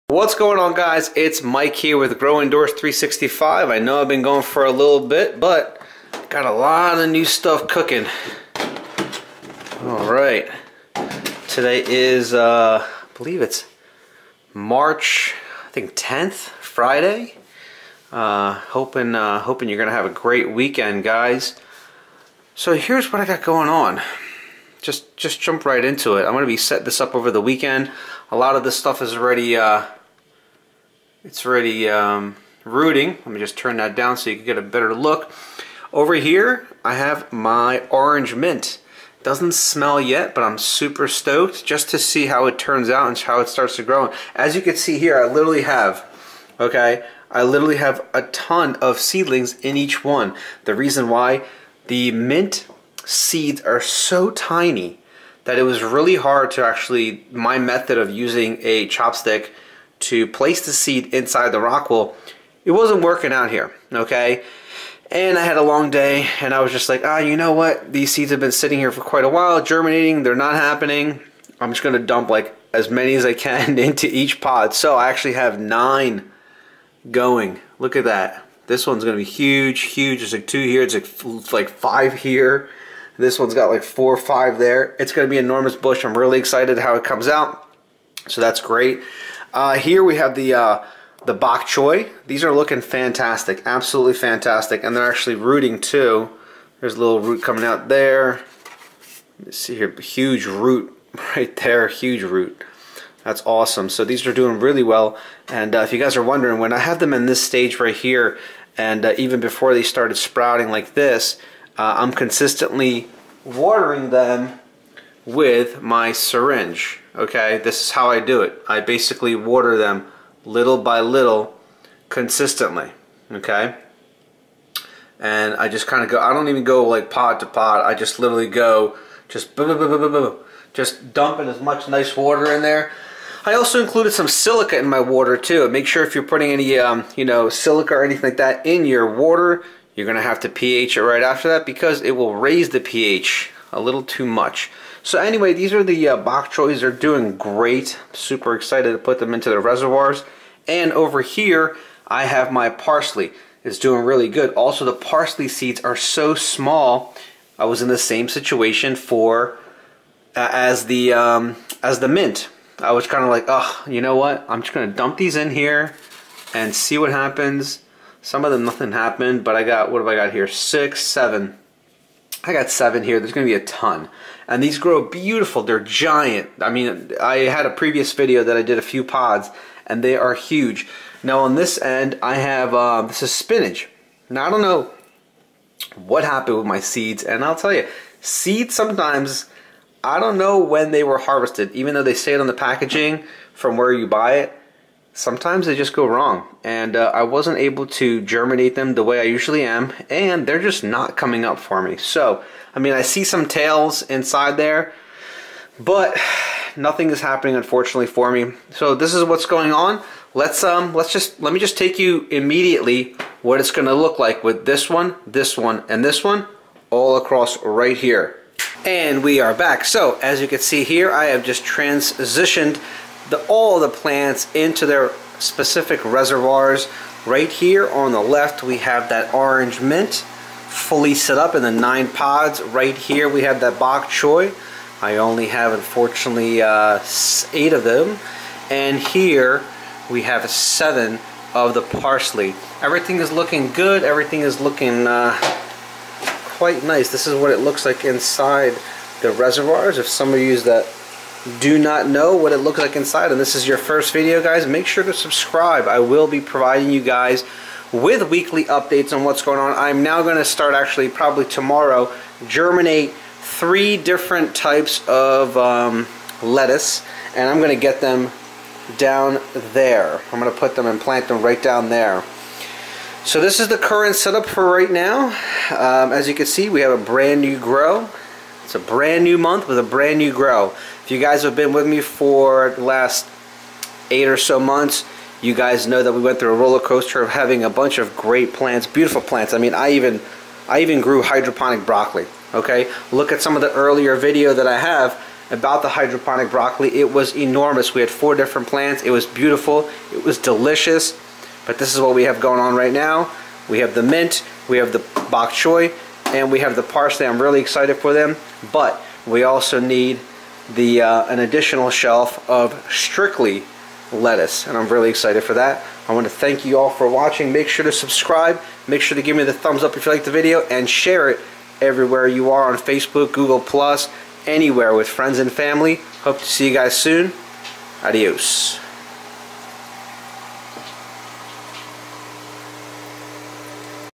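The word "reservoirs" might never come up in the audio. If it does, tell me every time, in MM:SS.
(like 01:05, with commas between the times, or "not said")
02:29, 03:46, 04:09.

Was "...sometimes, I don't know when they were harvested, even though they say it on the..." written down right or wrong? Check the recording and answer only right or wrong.
right.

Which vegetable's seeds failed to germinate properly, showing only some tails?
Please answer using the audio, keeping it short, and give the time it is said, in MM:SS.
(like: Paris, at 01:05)
Spinach, at 03:03.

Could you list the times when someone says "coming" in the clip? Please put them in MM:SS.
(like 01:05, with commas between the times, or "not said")
01:37, 03:21.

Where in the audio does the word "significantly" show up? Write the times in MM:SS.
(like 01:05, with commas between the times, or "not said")
not said.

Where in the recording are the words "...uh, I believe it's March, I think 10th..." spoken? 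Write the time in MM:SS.
00:12.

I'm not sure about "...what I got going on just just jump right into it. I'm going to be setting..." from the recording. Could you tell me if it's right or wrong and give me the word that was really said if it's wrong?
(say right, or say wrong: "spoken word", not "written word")
right.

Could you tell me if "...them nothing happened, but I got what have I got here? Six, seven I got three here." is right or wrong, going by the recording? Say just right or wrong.
wrong.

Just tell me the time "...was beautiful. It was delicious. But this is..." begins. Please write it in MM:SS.
04:59.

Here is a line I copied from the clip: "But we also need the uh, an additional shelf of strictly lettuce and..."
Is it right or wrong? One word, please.
right.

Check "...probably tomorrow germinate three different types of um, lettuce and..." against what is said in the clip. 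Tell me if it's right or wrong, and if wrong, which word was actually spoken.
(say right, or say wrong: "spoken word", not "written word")
right.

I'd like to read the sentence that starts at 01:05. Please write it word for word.
And I had a long day, and I was just like, ah, you know what?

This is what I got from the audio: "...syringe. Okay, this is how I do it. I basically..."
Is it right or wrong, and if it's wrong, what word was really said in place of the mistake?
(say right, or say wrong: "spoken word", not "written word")
right.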